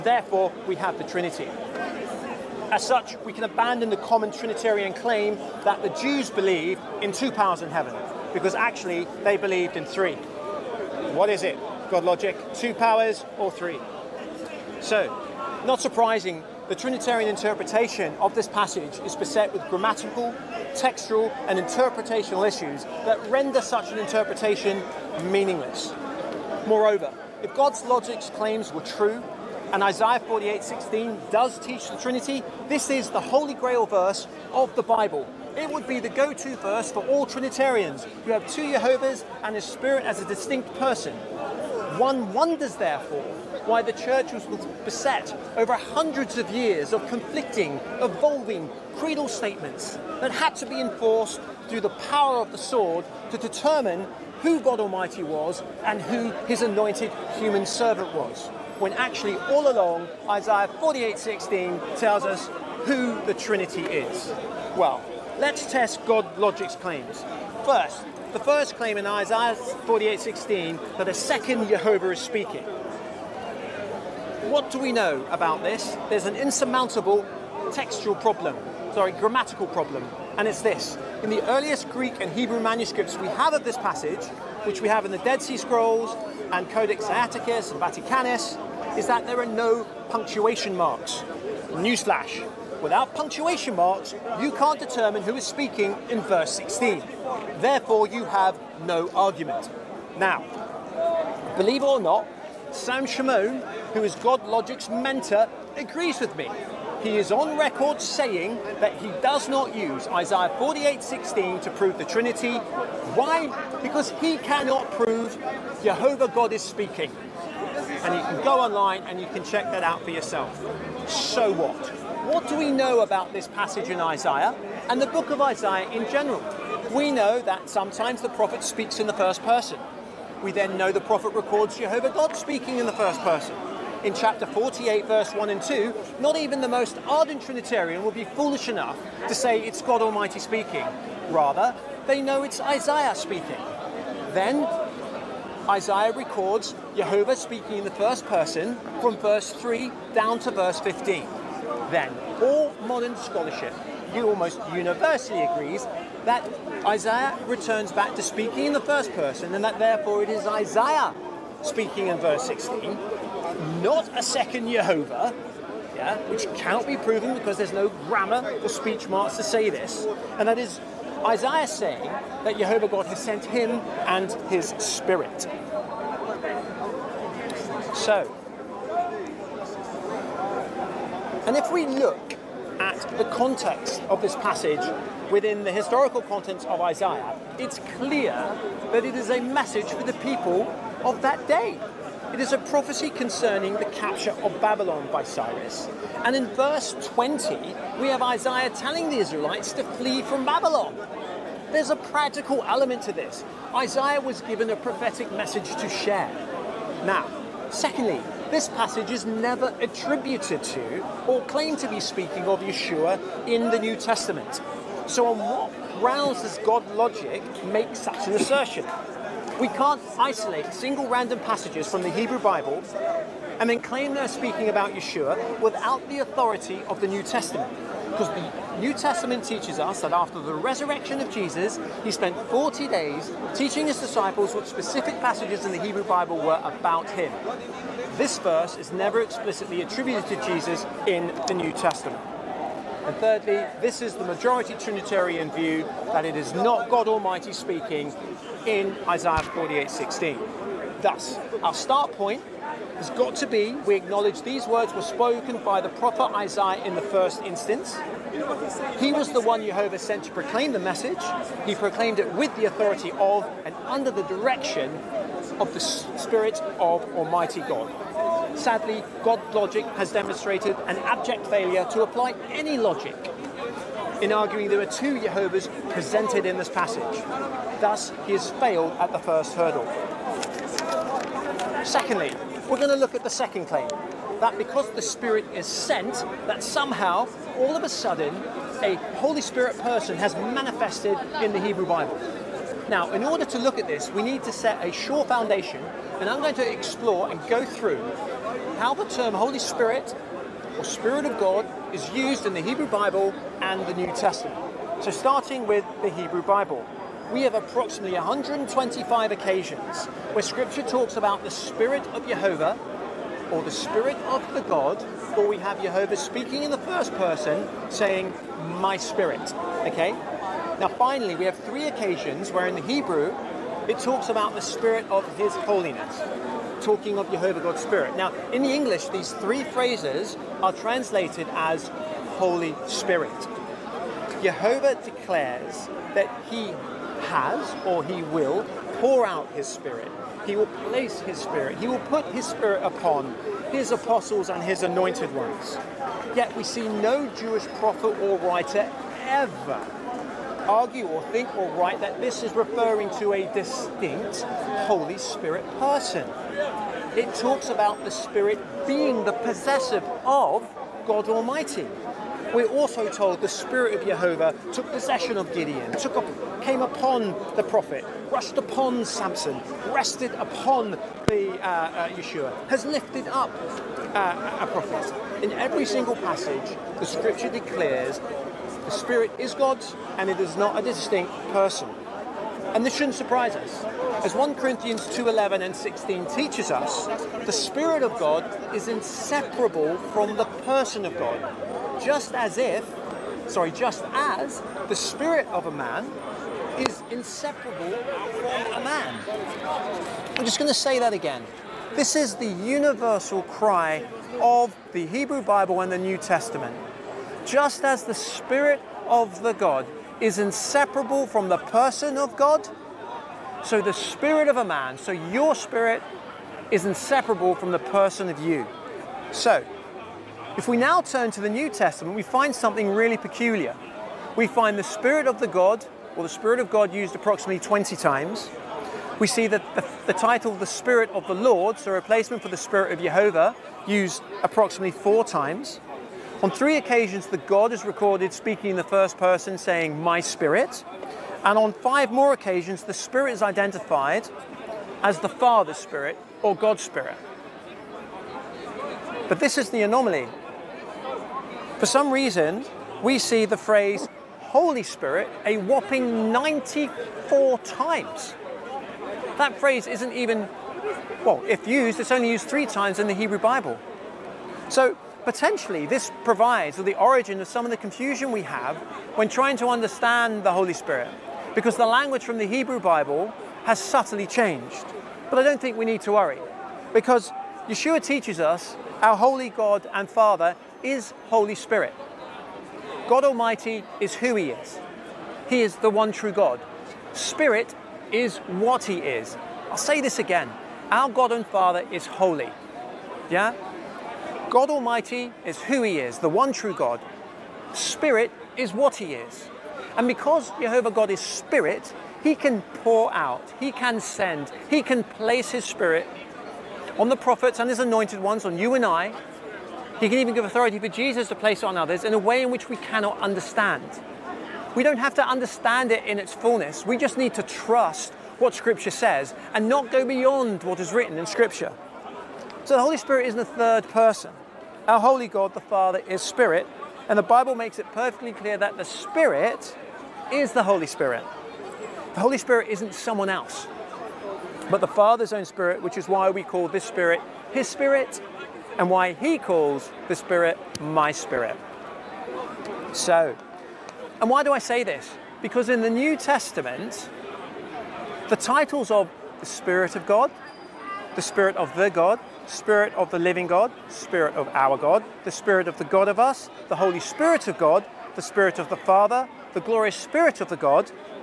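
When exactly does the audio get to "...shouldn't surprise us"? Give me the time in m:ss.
6:22.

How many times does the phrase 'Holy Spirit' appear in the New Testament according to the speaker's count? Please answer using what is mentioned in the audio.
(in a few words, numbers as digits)
94.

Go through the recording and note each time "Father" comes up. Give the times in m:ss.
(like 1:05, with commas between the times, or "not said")
7:25, 8:00, 8:11, 8:45, 8:54, 9:18.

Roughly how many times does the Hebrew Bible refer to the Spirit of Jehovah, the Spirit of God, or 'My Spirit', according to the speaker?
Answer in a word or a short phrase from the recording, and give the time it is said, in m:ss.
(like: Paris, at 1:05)
125, at 5:07.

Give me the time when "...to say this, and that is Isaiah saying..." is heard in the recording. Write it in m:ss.
2:49.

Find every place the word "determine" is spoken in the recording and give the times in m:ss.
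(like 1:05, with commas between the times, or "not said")
0:53, 1:34.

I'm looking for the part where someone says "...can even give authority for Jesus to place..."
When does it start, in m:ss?
8:30.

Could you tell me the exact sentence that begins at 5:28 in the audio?
Now, in the English, these three phrases are translated as Holy Spirit.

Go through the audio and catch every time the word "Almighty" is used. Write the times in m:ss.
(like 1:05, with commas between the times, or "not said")
0:54, 2:20, 4:07, 4:27, 6:01, 8:03, 8:14.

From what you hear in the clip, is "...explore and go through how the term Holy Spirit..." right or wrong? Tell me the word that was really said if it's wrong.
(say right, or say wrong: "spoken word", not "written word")
right.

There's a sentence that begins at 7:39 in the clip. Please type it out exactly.
That phrase isn't even, well, if used, it's only used three times in the Hebrew Bible.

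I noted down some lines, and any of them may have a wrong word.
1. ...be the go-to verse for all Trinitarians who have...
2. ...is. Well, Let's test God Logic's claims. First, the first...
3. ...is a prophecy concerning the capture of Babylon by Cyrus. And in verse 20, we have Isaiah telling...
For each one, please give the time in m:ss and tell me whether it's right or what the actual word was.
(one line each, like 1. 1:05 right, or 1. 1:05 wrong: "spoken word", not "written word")
1. 0:35 right
2. 1:03 right
3. 3:12 right.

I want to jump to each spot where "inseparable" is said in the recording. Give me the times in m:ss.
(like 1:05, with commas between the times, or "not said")
6:28, 6:37, 6:50, 6:56.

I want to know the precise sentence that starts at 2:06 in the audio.
We know that sometimes the prophet speaks in the first person.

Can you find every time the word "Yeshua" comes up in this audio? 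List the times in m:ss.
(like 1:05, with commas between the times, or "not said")
3:32, 3:44, 6:12, 7:57.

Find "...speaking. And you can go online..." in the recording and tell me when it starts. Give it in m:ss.
1:56.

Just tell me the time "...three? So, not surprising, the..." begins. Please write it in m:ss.
0:13.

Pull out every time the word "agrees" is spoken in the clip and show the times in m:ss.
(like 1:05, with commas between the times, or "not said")
1:45, 2:35.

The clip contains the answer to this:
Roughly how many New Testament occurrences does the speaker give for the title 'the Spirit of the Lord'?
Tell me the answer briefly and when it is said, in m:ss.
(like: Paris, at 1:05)
4, at 7:14.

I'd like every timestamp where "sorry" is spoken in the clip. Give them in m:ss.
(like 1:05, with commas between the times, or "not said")
1:18, 6:33.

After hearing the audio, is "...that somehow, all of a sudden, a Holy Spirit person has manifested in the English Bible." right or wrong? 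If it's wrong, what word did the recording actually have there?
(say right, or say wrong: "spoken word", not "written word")
wrong: "Hebrew", not "English".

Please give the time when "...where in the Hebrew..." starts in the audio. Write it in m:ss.
5:22.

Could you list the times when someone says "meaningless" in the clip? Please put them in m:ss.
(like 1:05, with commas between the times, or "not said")
0:25.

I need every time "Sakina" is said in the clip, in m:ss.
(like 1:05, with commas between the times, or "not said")
not said.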